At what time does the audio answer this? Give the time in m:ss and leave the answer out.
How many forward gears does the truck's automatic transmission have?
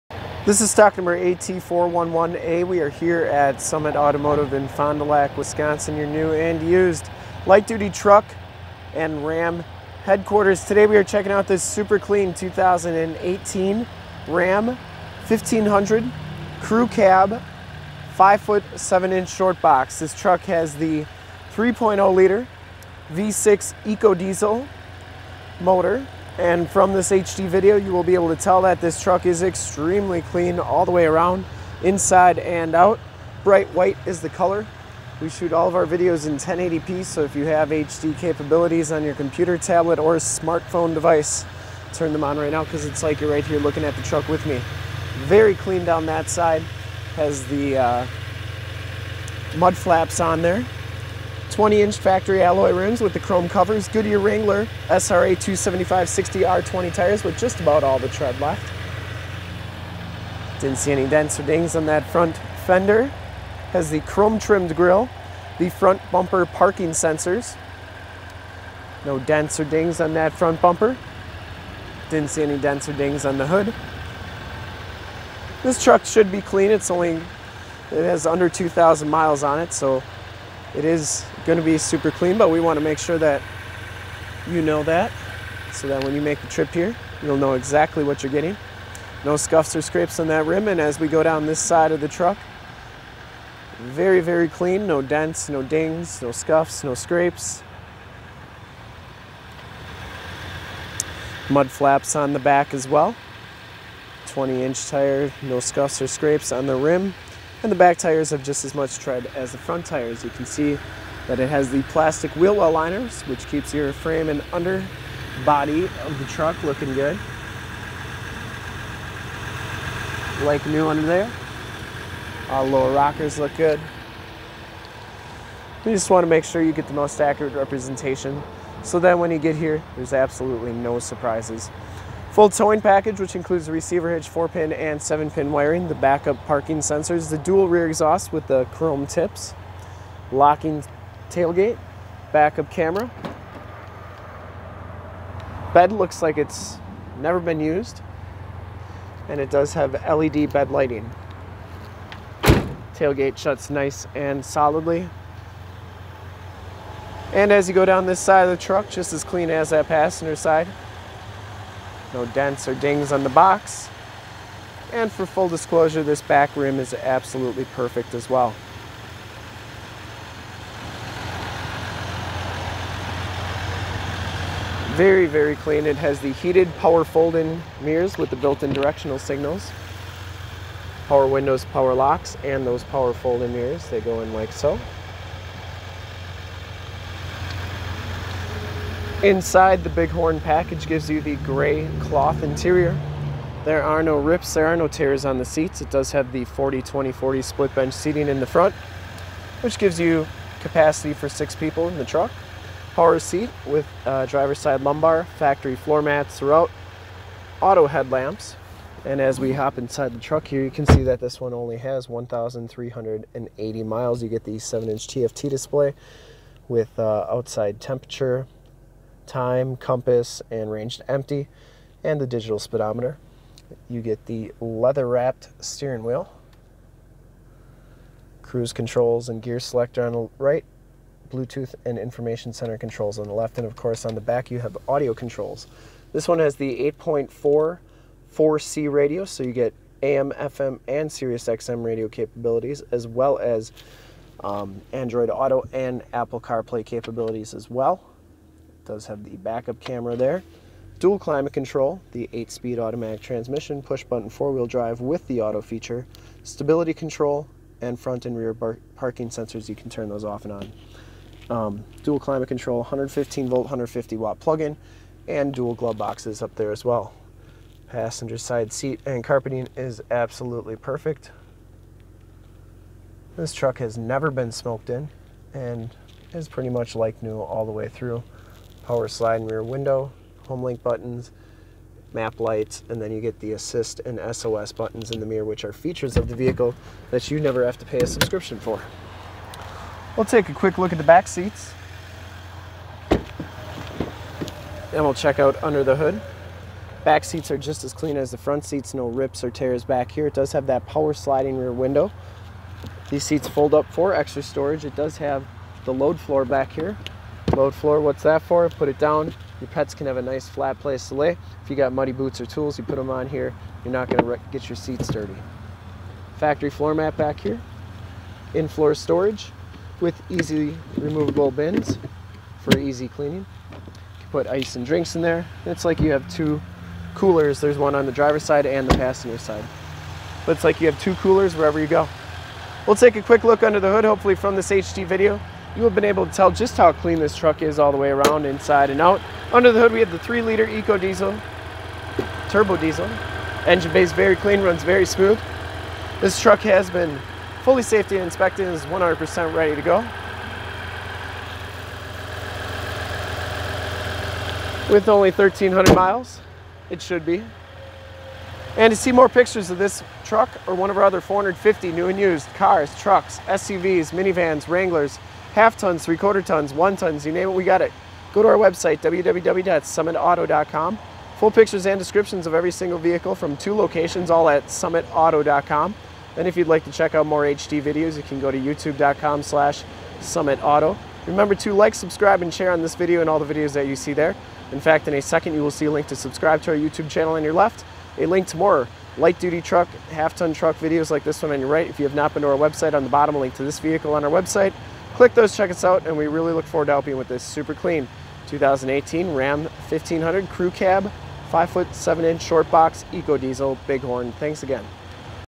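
4:12.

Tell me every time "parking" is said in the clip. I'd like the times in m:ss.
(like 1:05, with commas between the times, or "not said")
1:06, 2:16, 4:18.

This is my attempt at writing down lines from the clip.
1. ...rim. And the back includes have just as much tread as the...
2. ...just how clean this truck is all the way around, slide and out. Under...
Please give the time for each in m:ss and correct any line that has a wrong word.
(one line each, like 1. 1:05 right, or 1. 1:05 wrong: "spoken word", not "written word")
1. 1:46 wrong: "tires", not "includes"
2. 5:36 wrong: "inside", not "slide".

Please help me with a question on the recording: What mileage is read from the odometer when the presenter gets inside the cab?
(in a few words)
1,380.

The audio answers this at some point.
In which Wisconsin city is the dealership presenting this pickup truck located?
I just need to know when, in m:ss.
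0:04.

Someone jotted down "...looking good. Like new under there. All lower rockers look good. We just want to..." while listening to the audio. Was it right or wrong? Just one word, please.
right.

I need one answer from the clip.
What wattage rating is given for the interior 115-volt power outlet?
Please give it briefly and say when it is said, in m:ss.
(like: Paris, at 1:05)
150 watt, at 4:23.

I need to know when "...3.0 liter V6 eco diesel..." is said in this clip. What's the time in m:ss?
0:21.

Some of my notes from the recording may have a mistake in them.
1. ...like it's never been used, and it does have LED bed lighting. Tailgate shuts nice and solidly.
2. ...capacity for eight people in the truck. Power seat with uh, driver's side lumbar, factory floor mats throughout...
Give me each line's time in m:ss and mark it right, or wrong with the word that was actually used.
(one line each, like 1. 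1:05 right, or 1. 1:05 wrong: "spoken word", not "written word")
1. 2:26 right
2. 3:20 wrong: "six", not "eight".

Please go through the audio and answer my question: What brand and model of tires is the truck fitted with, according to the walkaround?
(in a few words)
Goodyear Wrangler SRA.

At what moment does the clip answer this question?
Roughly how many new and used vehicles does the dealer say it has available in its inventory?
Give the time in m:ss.
6:01.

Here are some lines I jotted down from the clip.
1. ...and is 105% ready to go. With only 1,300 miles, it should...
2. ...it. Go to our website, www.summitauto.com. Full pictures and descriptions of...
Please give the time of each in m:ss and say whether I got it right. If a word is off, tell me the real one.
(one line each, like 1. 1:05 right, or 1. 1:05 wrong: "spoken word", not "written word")
1. 5:48 wrong: "100", not "105"
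2. 6:07 right.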